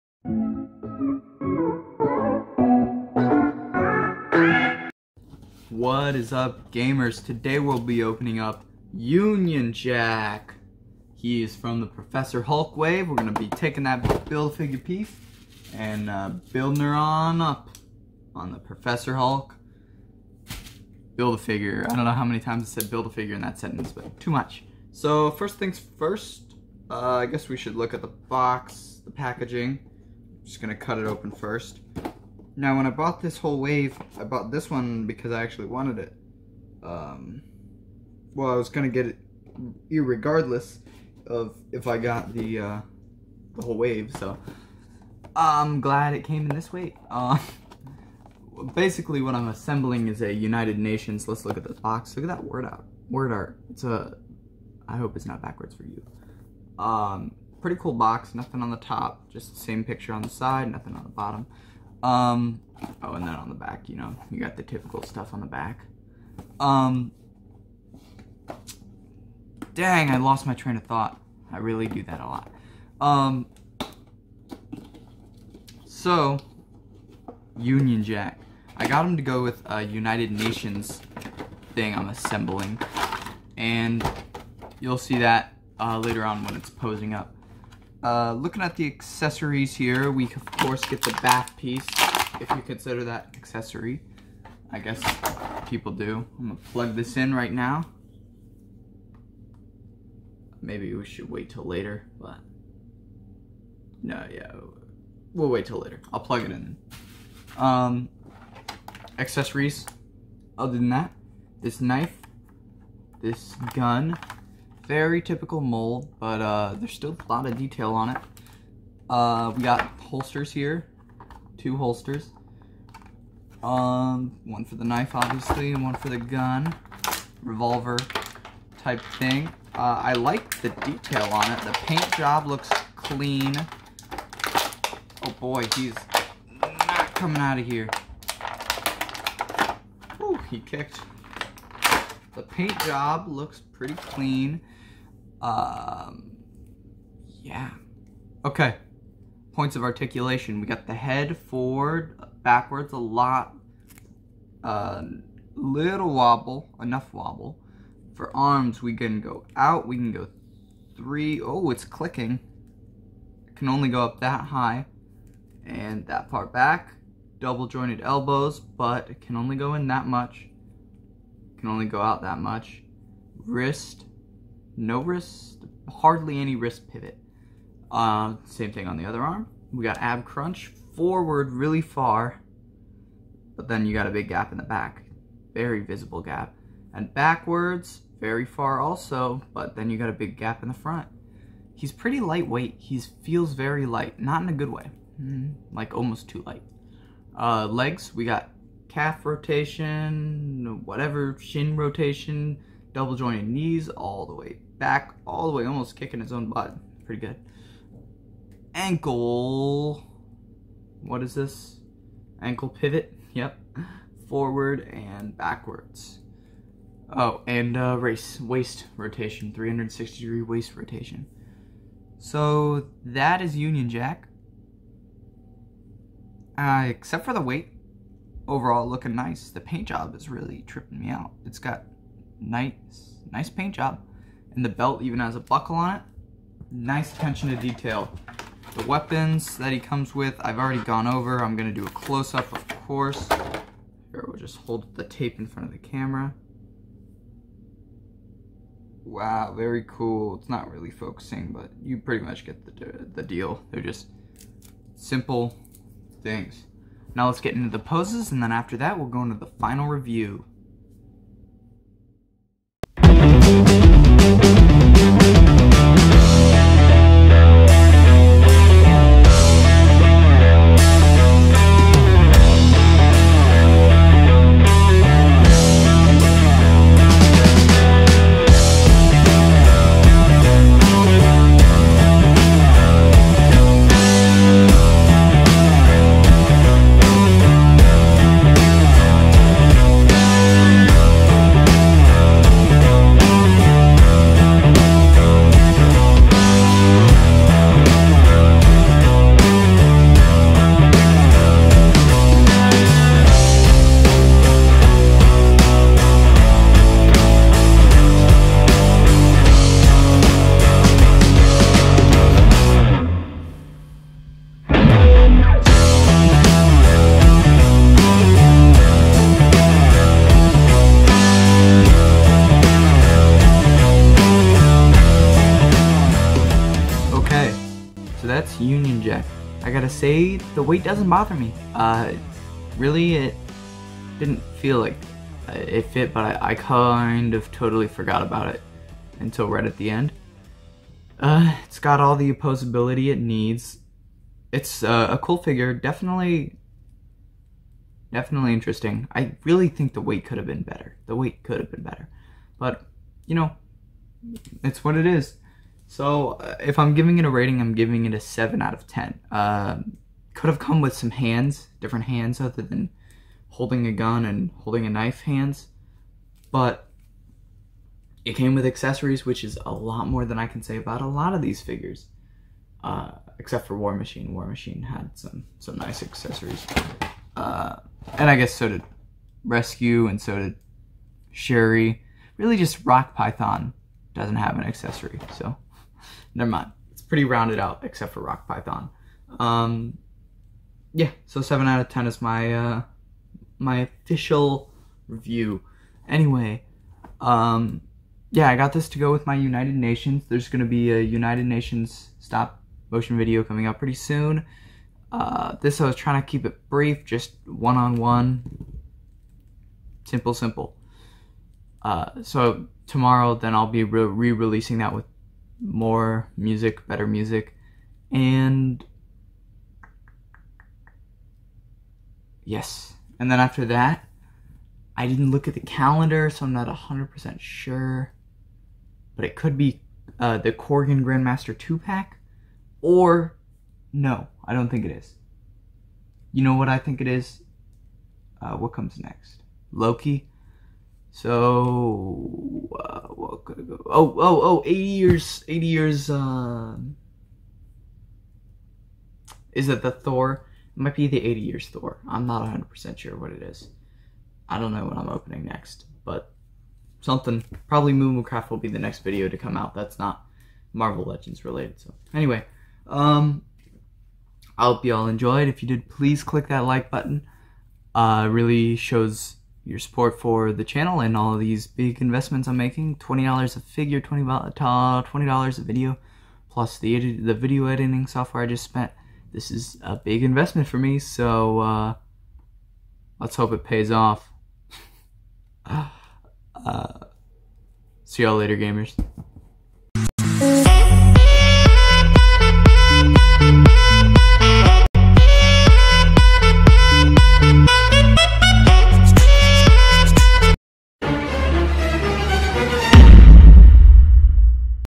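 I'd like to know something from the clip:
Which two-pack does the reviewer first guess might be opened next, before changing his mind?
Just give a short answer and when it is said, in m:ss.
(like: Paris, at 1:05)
Korg and Grandmaster, at 7:10.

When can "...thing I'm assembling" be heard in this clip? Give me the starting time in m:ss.
1:21.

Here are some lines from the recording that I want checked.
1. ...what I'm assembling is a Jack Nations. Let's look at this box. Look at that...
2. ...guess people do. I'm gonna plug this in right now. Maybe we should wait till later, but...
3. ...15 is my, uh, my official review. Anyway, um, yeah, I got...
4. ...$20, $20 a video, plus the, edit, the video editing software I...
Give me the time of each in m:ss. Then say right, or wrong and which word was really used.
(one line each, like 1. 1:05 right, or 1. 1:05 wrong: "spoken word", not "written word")
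1. 0:49 wrong: "United", not "Jack"
2. 1:34 right
3. 6:31 wrong: "10", not "15"
4. 7:54 right.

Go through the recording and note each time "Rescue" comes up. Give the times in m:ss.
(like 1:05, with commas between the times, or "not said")
6:19.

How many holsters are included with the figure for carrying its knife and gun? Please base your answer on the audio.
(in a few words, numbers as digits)
2.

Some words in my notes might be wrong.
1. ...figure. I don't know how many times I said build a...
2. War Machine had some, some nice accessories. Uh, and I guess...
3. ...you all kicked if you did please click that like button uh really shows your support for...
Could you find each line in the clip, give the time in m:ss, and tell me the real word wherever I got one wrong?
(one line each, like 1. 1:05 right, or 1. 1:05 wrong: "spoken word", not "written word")
1. 0:21 right
2. 6:14 right
3. 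7:44 wrong: "enjoyed", not "kicked".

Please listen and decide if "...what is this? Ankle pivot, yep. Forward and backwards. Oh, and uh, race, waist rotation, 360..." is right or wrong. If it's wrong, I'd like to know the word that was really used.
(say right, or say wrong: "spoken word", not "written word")
right.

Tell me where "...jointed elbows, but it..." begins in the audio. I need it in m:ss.
2:47.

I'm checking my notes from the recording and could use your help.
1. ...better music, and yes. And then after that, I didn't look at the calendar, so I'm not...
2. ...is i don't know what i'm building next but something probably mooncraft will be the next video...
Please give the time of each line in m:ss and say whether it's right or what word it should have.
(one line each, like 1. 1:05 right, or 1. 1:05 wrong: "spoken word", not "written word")
1. 6:56 right
2. 7:33 wrong: "opening", not "building".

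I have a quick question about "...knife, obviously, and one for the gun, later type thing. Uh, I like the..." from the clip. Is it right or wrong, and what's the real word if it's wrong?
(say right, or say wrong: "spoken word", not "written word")
wrong: "revolver", not "later".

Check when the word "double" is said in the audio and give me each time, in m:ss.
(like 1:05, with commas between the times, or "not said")
2:47, 3:22.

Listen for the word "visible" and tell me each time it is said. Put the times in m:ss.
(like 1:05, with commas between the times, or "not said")
3:05.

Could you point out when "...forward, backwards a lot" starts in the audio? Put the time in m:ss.
2:31.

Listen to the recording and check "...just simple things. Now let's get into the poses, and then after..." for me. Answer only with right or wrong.
right.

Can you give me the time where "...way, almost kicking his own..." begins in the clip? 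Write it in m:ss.
3:25.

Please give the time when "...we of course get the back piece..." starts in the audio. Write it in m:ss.
1:30.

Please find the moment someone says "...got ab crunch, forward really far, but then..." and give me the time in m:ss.
2:59.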